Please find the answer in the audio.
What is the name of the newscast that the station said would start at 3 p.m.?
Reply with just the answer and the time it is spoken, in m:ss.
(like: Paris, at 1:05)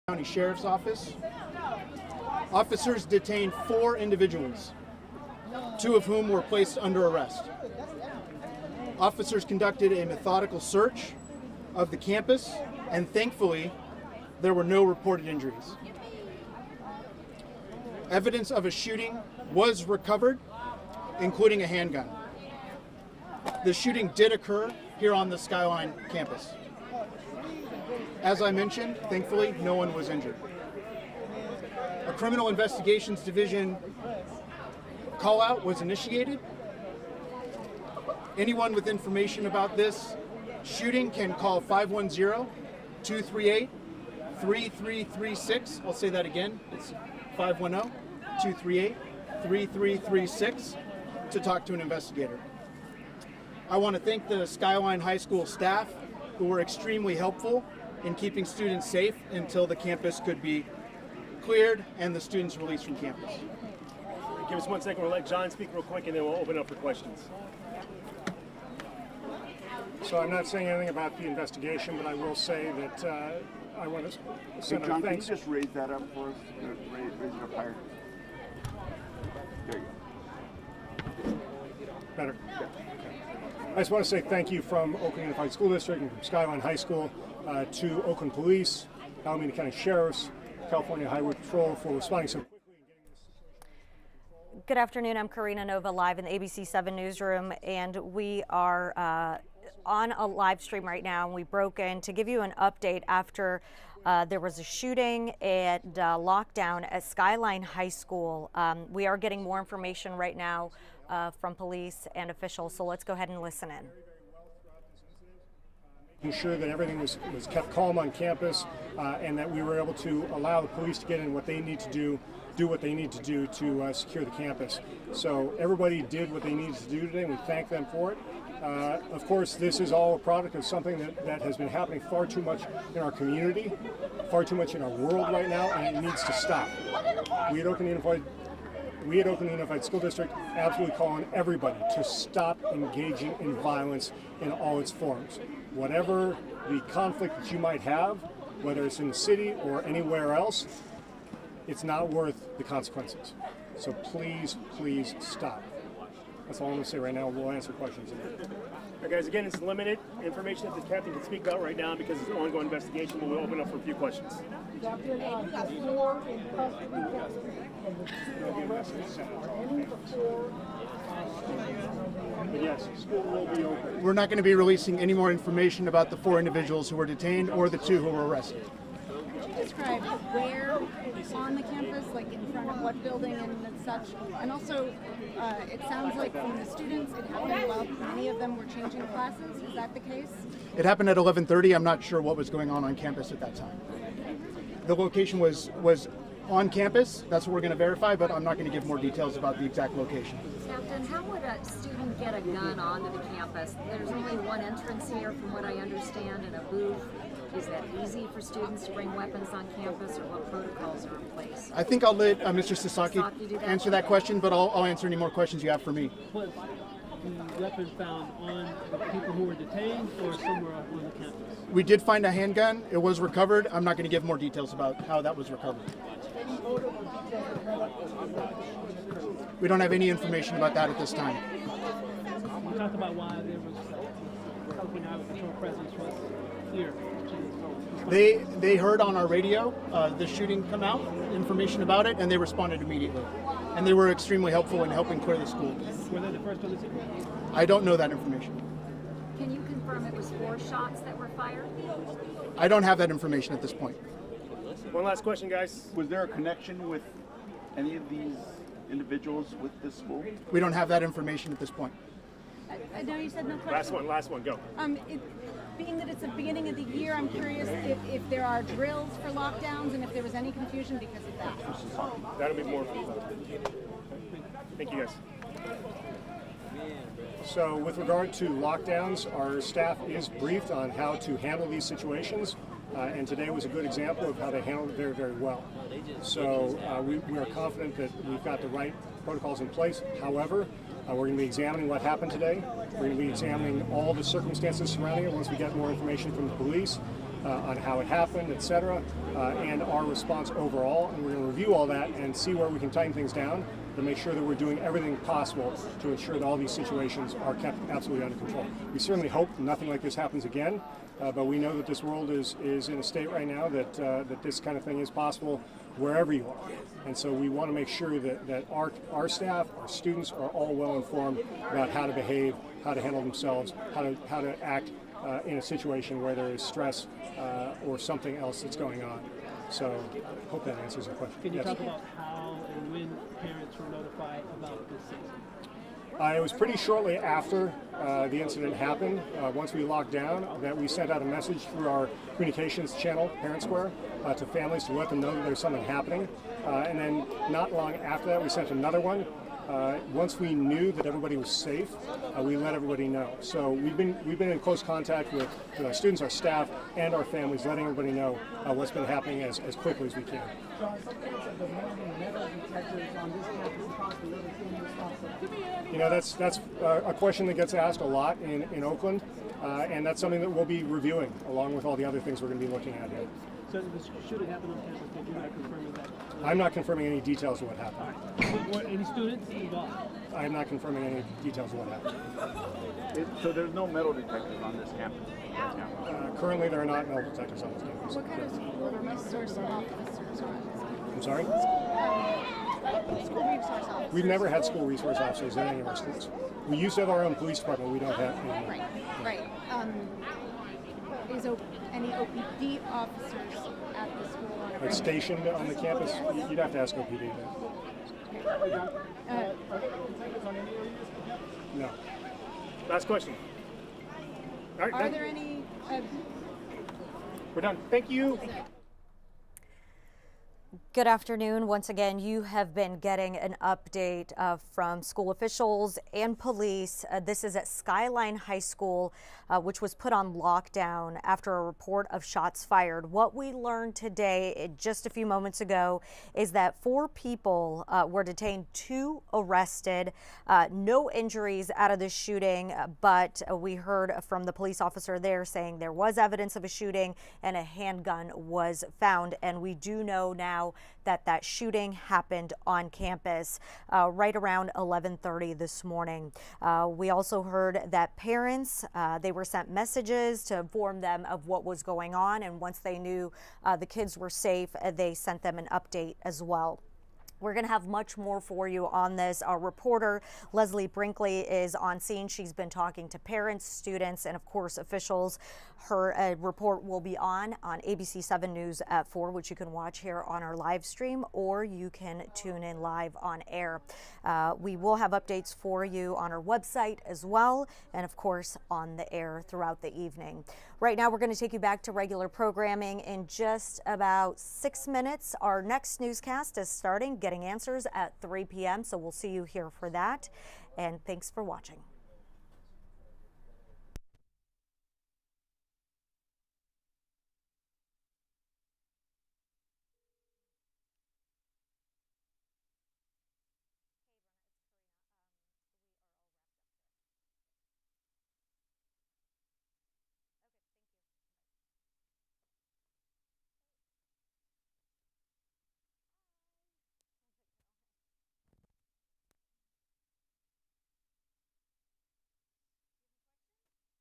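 Getting Answers, at 8:17.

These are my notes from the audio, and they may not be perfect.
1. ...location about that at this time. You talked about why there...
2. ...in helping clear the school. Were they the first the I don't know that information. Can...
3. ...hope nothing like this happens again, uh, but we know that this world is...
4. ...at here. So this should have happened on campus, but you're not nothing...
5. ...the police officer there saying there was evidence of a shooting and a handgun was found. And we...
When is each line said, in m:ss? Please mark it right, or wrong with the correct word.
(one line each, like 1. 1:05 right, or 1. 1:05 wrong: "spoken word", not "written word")
1. 3:50 wrong: "information", not "location"
2. 4:04 right
3. 5:09 right
4. 6:12 wrong: "confirming", not "nothing"
5. 7:24 right.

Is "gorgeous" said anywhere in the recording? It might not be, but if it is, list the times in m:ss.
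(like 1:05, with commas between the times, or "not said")
not said.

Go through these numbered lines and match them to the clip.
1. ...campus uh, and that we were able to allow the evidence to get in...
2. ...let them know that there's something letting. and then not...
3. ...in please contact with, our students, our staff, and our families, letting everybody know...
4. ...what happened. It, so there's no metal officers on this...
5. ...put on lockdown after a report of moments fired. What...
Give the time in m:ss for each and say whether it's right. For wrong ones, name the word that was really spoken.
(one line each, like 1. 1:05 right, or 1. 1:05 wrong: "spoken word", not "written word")
1. 1:58 wrong: "police", not "evidence"
2. 5:44 wrong: "happening", not "letting"
3. 5:54 wrong: "close", not "please"
4. 6:21 wrong: "detectors", not "officers"
5. 7:09 wrong: "shots", not "moments".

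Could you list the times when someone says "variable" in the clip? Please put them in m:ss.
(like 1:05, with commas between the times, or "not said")
not said.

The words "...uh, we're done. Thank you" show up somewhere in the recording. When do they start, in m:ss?
6:55.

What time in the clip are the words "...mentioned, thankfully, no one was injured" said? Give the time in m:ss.
0:28.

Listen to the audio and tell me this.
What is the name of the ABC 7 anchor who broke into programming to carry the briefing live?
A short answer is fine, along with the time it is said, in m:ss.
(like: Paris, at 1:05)
Karina Nova, at 1:35.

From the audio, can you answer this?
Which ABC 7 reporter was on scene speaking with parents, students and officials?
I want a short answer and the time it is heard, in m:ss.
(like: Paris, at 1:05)
Leslie Brinkley, at 7:50.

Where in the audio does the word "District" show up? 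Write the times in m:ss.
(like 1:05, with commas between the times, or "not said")
1:25, 2:19.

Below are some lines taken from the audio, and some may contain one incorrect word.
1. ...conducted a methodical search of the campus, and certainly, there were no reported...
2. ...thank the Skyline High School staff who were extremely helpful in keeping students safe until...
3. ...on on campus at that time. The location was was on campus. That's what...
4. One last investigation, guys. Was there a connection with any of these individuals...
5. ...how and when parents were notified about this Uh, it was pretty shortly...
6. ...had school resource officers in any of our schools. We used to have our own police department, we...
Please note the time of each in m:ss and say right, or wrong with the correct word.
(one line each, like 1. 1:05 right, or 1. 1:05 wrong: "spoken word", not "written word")
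1. 0:09 wrong: "thankfully", not "certainly"
2. 0:54 right
3. 3:12 right
4. 4:14 wrong: "question", not "investigation"
5. 5:32 right
6. 6:34 right.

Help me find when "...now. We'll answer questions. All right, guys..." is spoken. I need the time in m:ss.
2:37.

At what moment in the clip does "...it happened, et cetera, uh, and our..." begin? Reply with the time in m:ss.
4:57.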